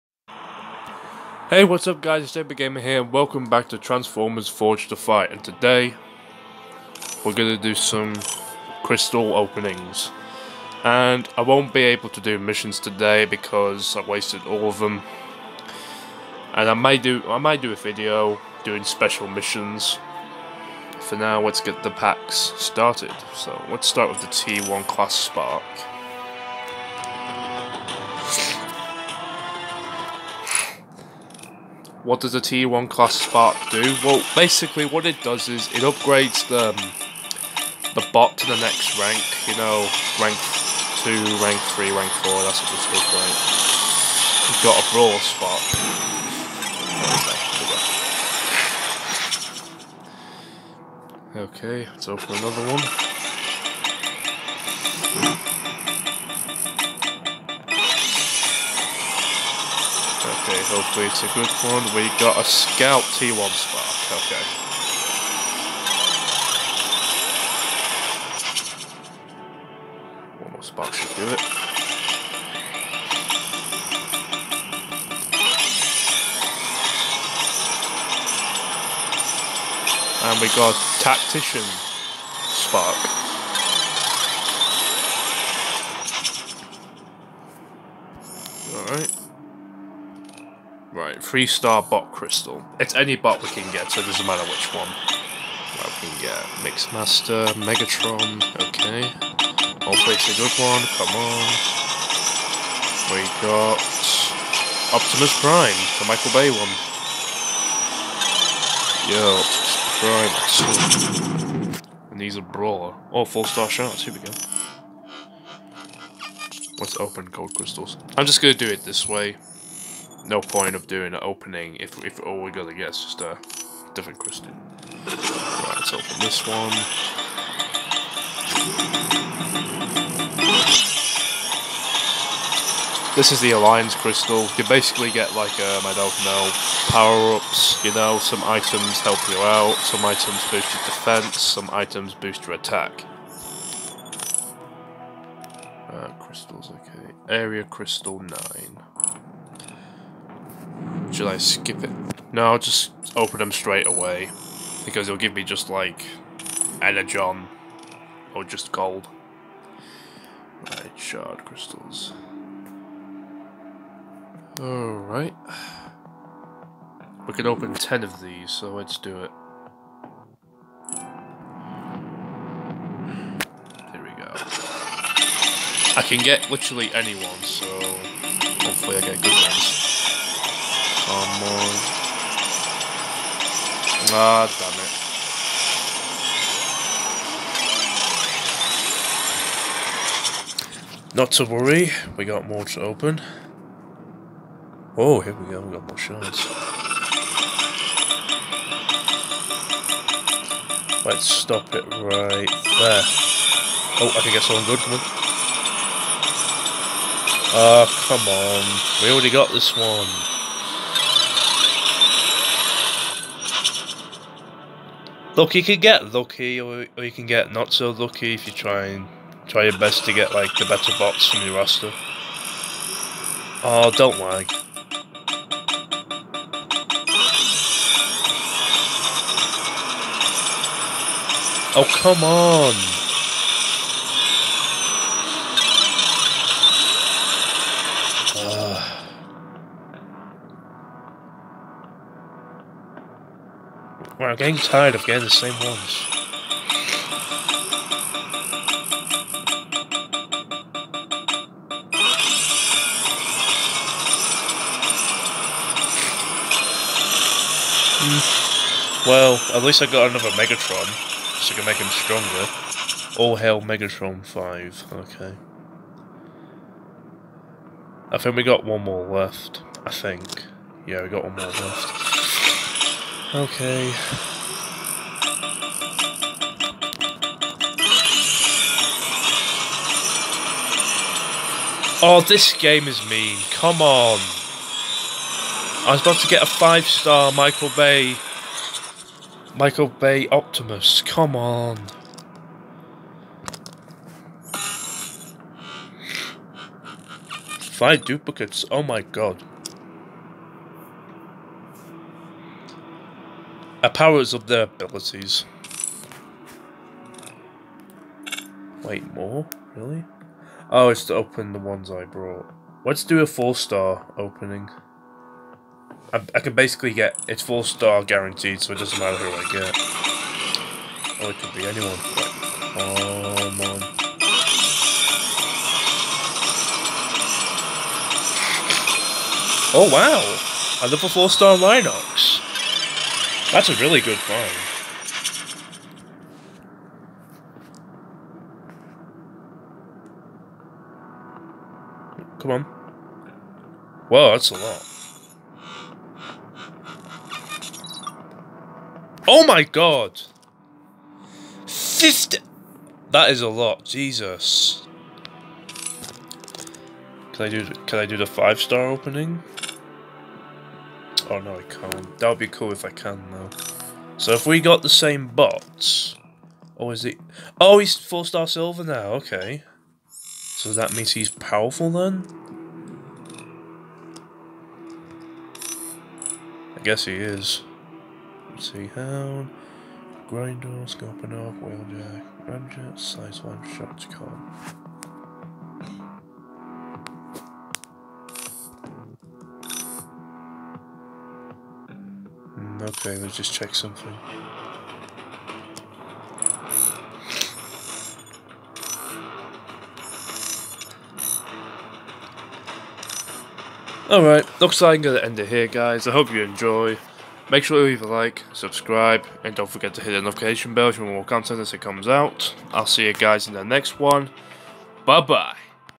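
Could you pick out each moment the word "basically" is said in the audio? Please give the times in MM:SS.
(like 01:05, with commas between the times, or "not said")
00:34, 02:14, 05:16.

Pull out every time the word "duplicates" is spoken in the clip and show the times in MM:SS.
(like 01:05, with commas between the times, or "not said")
04:58.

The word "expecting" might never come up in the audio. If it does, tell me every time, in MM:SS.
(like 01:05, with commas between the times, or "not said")
not said.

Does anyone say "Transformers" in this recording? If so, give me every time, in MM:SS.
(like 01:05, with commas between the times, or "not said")
00:03.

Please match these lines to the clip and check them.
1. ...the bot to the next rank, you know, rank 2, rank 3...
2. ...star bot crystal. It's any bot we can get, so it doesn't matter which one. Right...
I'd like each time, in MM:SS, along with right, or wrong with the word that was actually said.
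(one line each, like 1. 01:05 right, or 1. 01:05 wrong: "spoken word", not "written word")
1. 00:37 right
2. 01:31 right.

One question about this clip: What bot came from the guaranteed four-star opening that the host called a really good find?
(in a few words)
Linox.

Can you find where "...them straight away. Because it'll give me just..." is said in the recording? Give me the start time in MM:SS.
02:33.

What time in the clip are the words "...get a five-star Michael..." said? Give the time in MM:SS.
04:46.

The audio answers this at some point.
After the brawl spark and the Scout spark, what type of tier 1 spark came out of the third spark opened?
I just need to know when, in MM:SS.
01:21.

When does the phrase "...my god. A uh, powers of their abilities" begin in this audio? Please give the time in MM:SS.
04:58.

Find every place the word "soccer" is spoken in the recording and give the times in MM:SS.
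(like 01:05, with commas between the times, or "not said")
not said.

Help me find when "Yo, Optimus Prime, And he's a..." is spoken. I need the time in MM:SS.
01:49.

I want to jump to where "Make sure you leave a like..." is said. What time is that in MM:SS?
06:47.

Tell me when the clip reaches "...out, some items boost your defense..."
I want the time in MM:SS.
02:19.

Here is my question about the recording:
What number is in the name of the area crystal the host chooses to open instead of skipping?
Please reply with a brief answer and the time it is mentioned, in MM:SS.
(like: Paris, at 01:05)
9, at 02:27.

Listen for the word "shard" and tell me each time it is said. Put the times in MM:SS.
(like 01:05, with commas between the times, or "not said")
02:40, 03:15.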